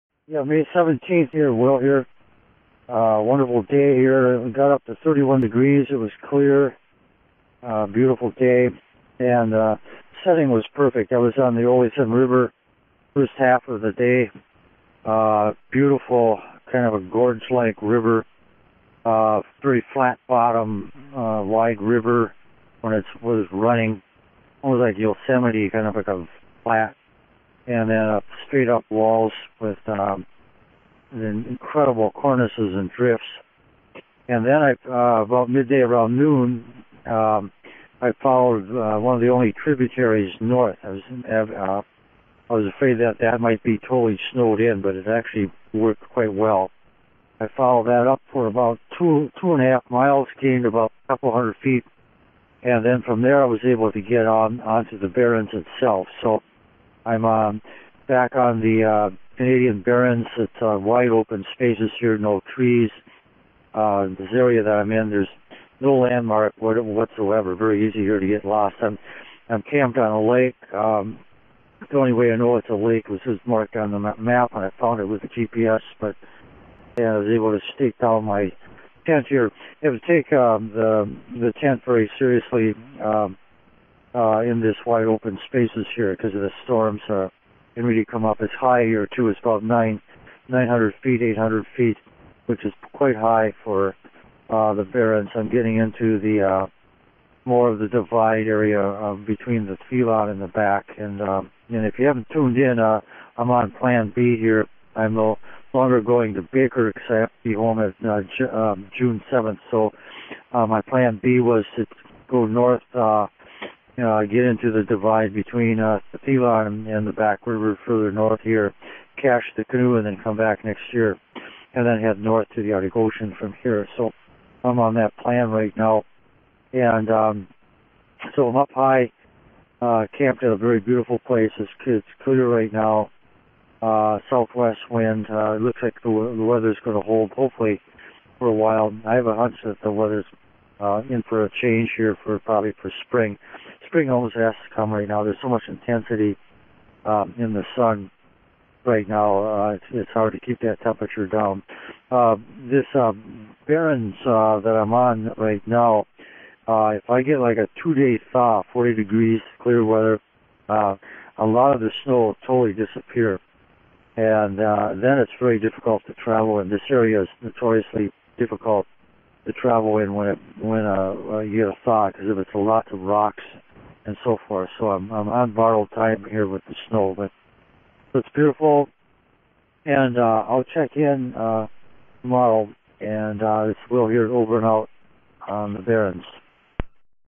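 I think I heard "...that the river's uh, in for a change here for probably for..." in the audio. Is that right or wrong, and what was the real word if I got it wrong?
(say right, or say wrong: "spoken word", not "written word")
wrong: "weather", not "river".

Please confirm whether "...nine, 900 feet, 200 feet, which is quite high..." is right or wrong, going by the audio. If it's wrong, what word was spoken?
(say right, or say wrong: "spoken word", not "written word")
wrong: "800", not "200".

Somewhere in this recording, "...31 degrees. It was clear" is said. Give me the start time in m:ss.
0:05.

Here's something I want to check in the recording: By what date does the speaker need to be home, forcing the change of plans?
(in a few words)
June 7.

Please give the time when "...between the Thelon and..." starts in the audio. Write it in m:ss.
1:39.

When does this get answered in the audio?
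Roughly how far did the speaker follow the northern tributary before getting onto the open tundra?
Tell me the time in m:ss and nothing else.
0:48.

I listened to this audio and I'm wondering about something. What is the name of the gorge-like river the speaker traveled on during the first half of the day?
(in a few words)
Oleson River.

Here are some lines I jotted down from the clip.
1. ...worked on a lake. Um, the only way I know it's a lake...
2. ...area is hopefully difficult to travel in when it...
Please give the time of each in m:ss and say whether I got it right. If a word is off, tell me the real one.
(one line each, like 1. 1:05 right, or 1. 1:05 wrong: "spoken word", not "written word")
1. 1:09 wrong: "camped", not "worked"
2. 2:46 wrong: "notoriously", not "hopefully".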